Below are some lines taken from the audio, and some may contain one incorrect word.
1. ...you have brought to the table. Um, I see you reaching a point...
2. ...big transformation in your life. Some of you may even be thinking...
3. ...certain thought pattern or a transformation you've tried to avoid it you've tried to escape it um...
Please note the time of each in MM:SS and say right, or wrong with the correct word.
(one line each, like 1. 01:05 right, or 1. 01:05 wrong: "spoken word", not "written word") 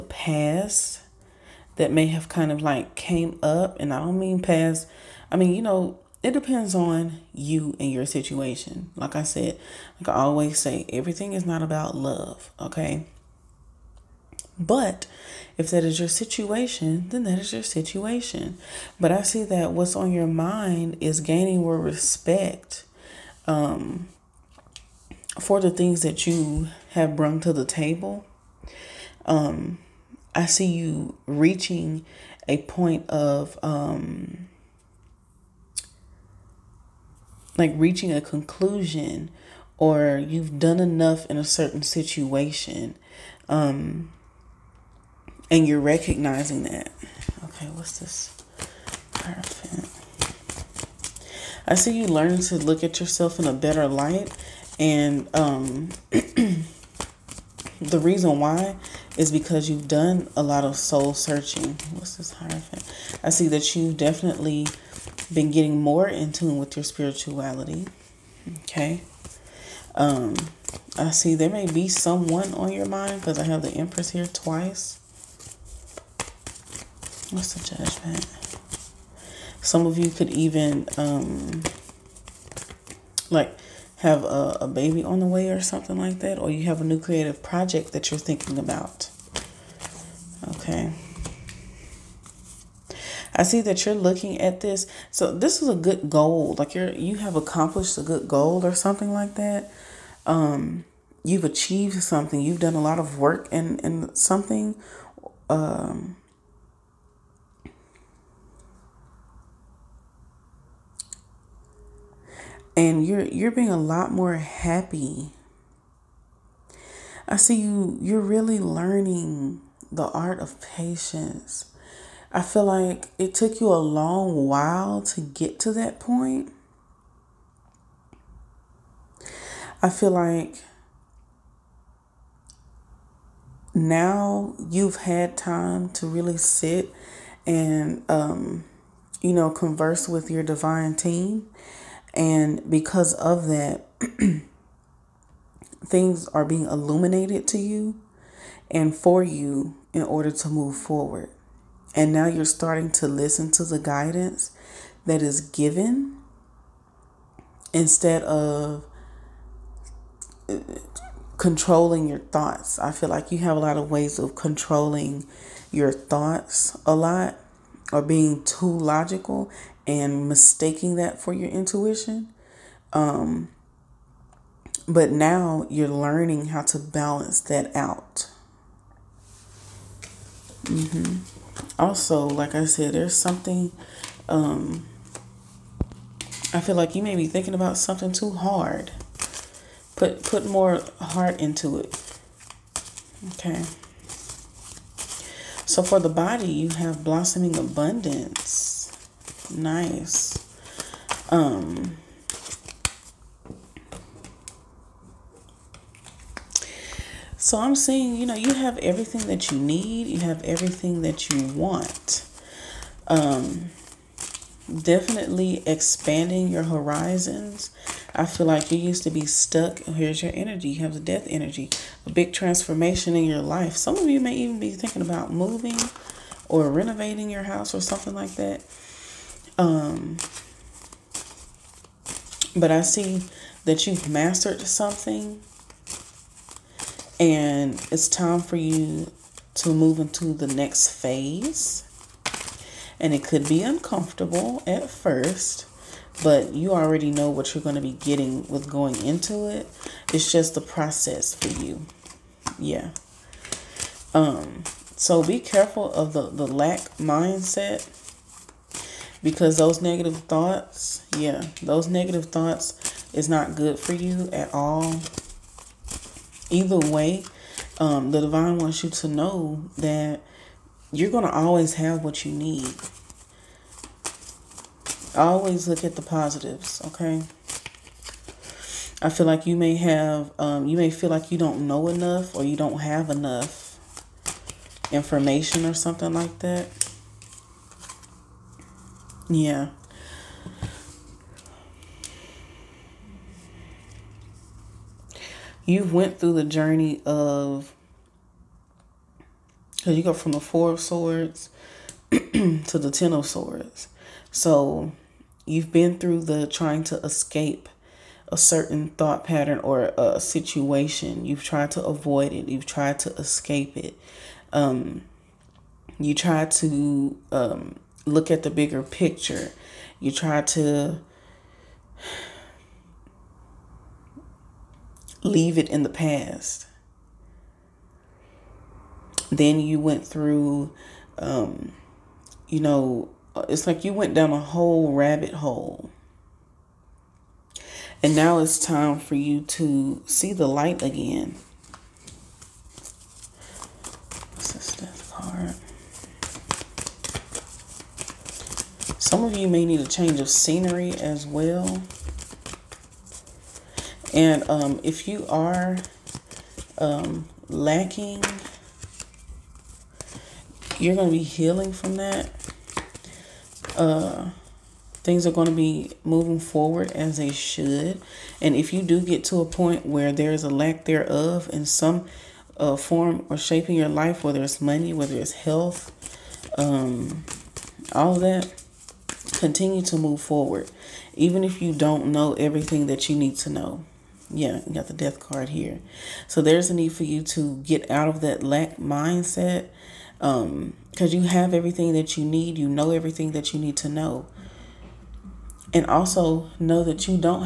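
1. 00:26 right
2. 03:42 right
3. 05:08 wrong: "situation", not "transformation".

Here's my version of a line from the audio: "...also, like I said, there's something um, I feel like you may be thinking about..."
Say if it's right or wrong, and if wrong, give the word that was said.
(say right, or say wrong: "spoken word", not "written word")
right.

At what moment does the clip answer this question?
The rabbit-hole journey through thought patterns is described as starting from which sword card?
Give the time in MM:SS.
05:00.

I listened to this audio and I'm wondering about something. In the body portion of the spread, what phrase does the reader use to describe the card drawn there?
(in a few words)
Blossoming abundance.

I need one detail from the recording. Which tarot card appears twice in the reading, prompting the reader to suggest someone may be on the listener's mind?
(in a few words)
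The Empress.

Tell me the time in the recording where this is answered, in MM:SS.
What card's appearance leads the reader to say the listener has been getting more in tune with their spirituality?
01:02.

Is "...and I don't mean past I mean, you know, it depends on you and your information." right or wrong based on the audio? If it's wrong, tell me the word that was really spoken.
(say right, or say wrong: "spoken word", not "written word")
wrong: "situation", not "information".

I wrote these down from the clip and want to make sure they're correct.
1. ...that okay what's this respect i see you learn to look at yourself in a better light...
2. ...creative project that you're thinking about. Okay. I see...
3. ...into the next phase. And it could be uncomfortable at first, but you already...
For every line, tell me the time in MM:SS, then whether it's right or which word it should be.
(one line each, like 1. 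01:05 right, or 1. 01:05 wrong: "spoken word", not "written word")
1. 00:46 wrong: "perfect", not "respect"
2. 01:26 right
3. 03:59 right.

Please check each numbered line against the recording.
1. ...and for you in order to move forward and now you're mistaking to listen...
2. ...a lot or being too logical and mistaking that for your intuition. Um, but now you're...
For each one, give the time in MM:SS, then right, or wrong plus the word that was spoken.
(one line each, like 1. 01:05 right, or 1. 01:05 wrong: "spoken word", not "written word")
1. 02:28 wrong: "starting", not "mistaking"
2. 02:46 right.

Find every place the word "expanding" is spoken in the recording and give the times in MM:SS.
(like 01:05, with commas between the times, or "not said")
03:35.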